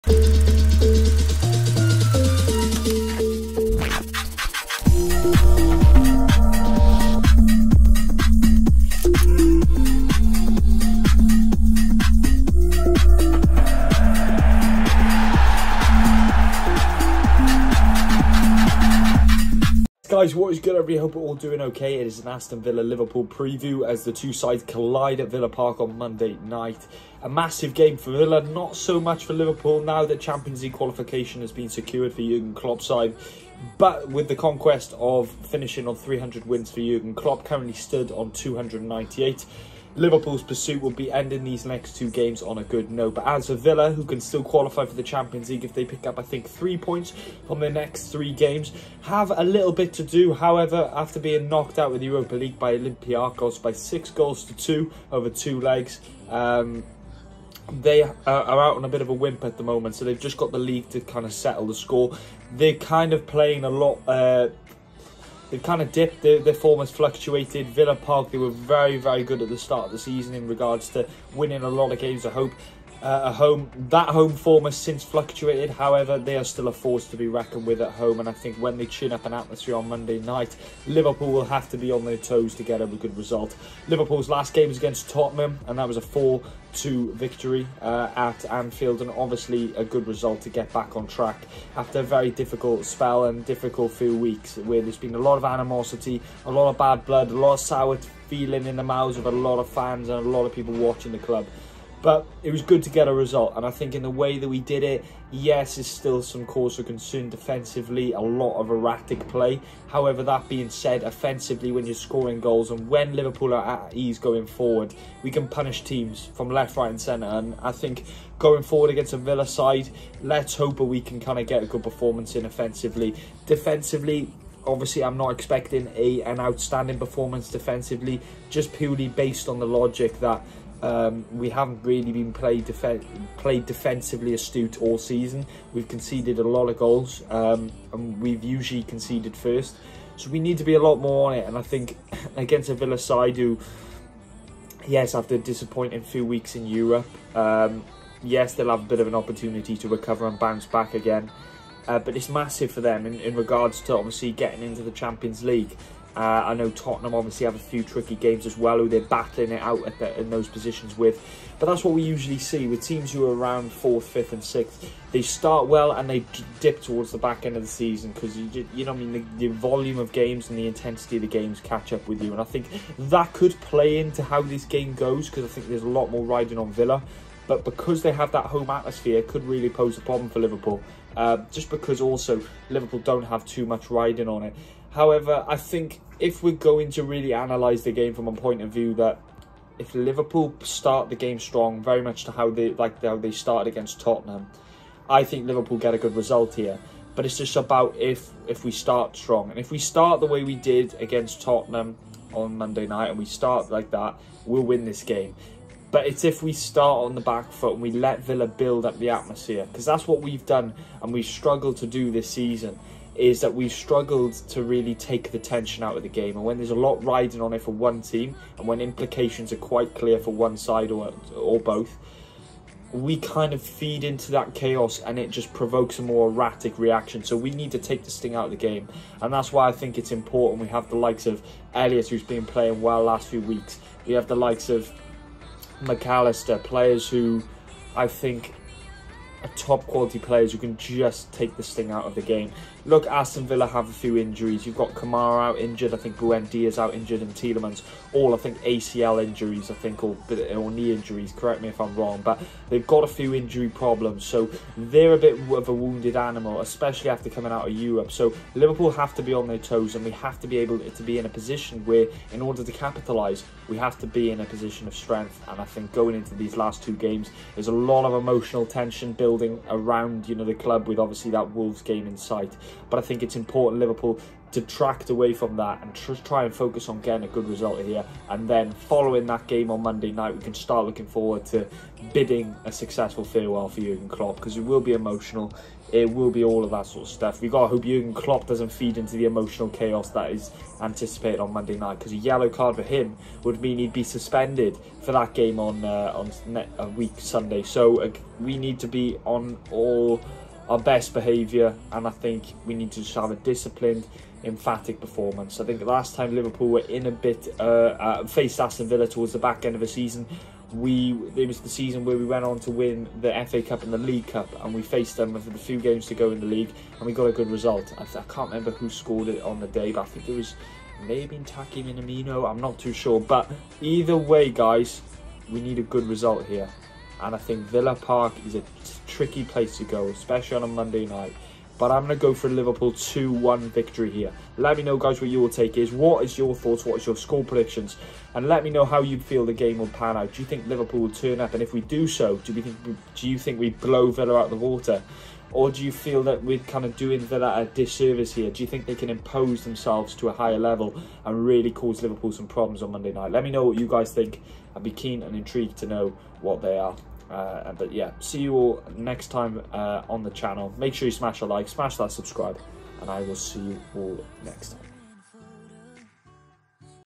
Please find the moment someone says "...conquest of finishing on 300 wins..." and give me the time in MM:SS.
00:34.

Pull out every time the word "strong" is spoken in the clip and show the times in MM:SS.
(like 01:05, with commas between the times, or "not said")
03:11, 03:19.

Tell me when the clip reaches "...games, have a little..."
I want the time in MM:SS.
00:48.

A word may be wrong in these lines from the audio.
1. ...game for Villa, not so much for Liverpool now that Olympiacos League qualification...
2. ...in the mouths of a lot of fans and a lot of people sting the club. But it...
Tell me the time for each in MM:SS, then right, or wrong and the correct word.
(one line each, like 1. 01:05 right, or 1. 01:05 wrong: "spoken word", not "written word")
1. 00:27 wrong: "Champions", not "Olympiacos"
2. 01:38 wrong: "watching", not "sting".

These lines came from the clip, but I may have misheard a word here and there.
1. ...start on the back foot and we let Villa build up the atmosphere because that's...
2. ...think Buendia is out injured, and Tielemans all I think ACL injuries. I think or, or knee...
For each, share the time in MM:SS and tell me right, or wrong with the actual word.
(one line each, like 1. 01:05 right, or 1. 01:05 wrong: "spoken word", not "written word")
1. 03:26 right
2. 04:05 right.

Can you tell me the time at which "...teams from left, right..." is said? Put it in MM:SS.
01:55.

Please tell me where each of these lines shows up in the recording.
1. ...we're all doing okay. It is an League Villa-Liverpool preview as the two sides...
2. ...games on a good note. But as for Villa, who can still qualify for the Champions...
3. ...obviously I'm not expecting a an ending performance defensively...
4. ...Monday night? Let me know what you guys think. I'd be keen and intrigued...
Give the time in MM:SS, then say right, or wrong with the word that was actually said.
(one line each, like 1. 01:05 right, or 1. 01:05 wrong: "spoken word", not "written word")
1. 00:21 wrong: "Aston", not "League"
2. 00:42 right
3. 02:04 wrong: "outstanding", not "ending"
4. 05:52 right.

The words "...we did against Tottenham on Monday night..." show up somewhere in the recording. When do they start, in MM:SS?
03:20.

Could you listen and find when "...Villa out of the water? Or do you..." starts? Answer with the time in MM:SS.
05:44.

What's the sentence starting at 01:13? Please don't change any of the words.
Uh, a home that home form has since fluctuated.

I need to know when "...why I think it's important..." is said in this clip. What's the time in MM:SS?
03:49.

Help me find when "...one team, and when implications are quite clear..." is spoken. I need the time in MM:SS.
03:37.